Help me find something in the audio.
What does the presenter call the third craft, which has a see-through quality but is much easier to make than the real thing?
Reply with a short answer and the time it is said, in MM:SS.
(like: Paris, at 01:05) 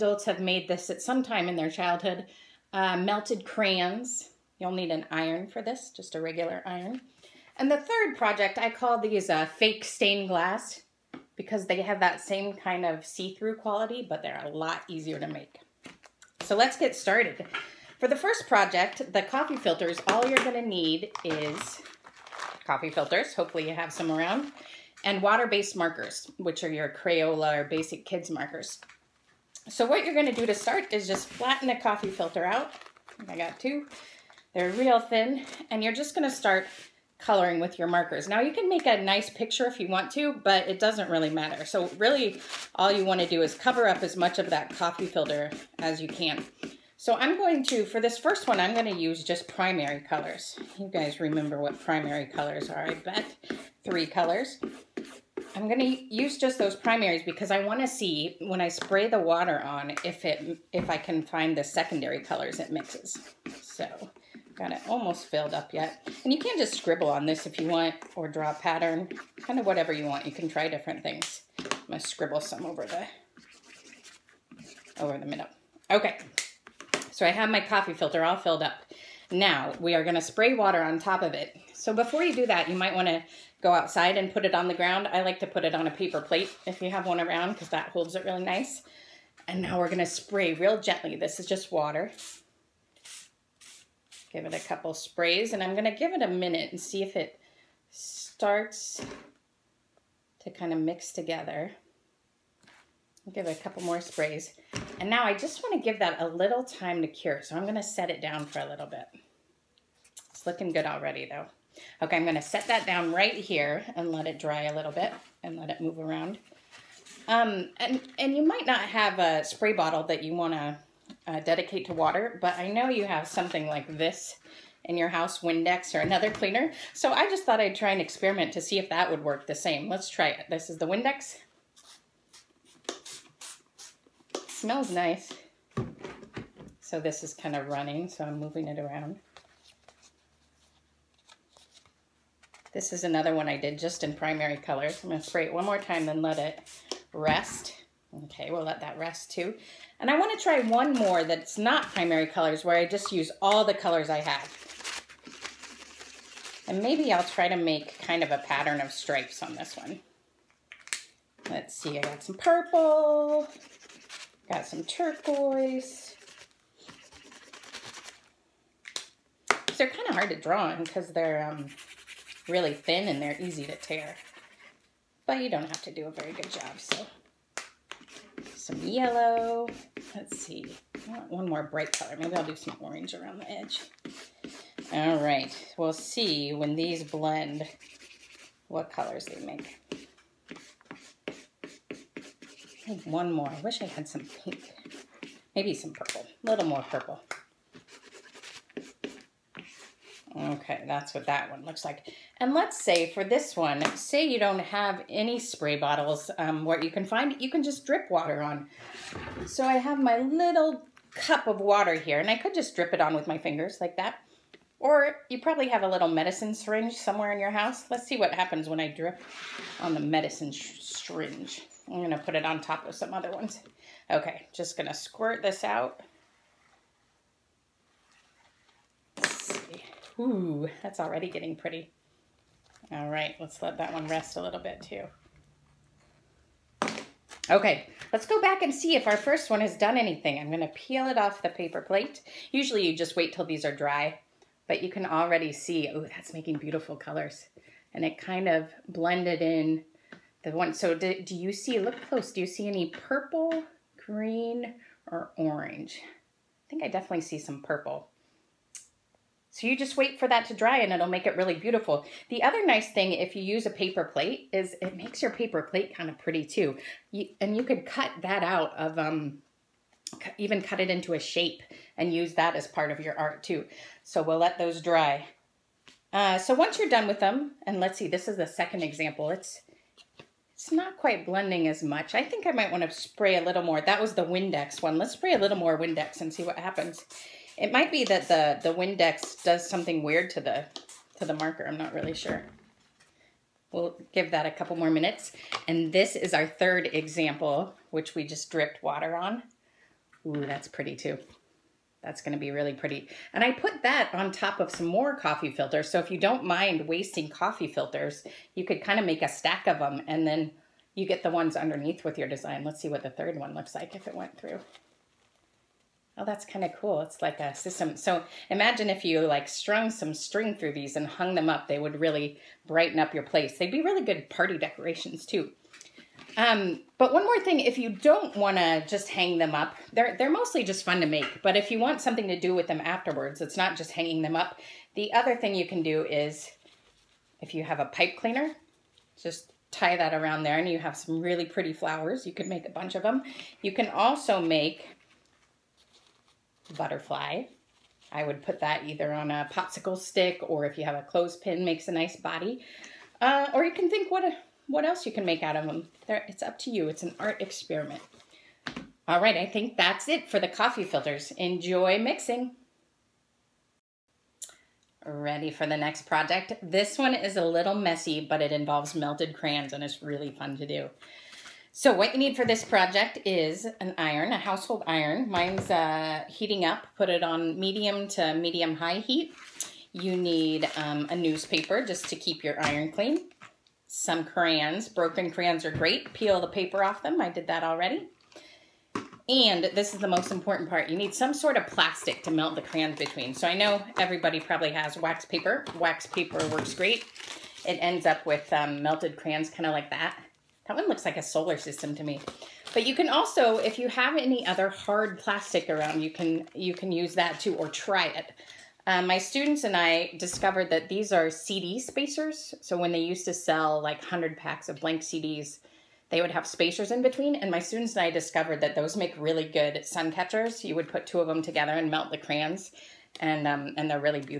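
Fake stained glass, at 00:09.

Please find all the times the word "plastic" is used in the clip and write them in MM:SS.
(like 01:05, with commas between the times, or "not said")
06:31, 06:45.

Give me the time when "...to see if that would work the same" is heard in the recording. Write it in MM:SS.
02:08.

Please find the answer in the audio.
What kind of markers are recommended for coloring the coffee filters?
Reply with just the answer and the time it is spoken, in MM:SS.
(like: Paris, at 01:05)
Water-based markers, at 00:25.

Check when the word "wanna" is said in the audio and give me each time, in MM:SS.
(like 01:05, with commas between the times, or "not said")
00:43, 00:57, 01:22.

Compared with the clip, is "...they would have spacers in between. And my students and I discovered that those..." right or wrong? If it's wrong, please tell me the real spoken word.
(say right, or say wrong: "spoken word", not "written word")
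right.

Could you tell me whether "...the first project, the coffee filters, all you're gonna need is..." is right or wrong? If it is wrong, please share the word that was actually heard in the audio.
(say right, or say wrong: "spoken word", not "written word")
right.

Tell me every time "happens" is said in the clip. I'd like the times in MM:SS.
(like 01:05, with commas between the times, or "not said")
03:38, 04:46.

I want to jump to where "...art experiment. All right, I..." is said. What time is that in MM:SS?
05:57.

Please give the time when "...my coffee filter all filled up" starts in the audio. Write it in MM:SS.
01:17.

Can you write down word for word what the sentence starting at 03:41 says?
I'm gonna put it on top of some other ones.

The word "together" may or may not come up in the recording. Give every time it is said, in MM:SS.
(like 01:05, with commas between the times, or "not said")
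01:41, 07:01.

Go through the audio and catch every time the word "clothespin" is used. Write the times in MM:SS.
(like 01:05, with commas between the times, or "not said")
05:51.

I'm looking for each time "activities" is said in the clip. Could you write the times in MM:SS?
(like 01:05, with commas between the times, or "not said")
not said.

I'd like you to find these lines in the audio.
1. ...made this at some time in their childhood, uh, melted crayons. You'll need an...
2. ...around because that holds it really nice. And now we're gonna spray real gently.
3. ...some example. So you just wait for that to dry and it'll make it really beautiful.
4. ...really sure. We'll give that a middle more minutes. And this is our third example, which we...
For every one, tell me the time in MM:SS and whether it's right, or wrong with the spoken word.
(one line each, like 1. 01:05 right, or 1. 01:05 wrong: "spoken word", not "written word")
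1. 00:00 right
2. 01:27 right
3. 04:17 wrong: "purple", not "example"
4. 04:51 wrong: "couple", not "middle".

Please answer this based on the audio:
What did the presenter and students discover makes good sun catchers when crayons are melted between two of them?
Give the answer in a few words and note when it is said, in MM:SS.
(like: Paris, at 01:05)
CD spacers, at 06:51.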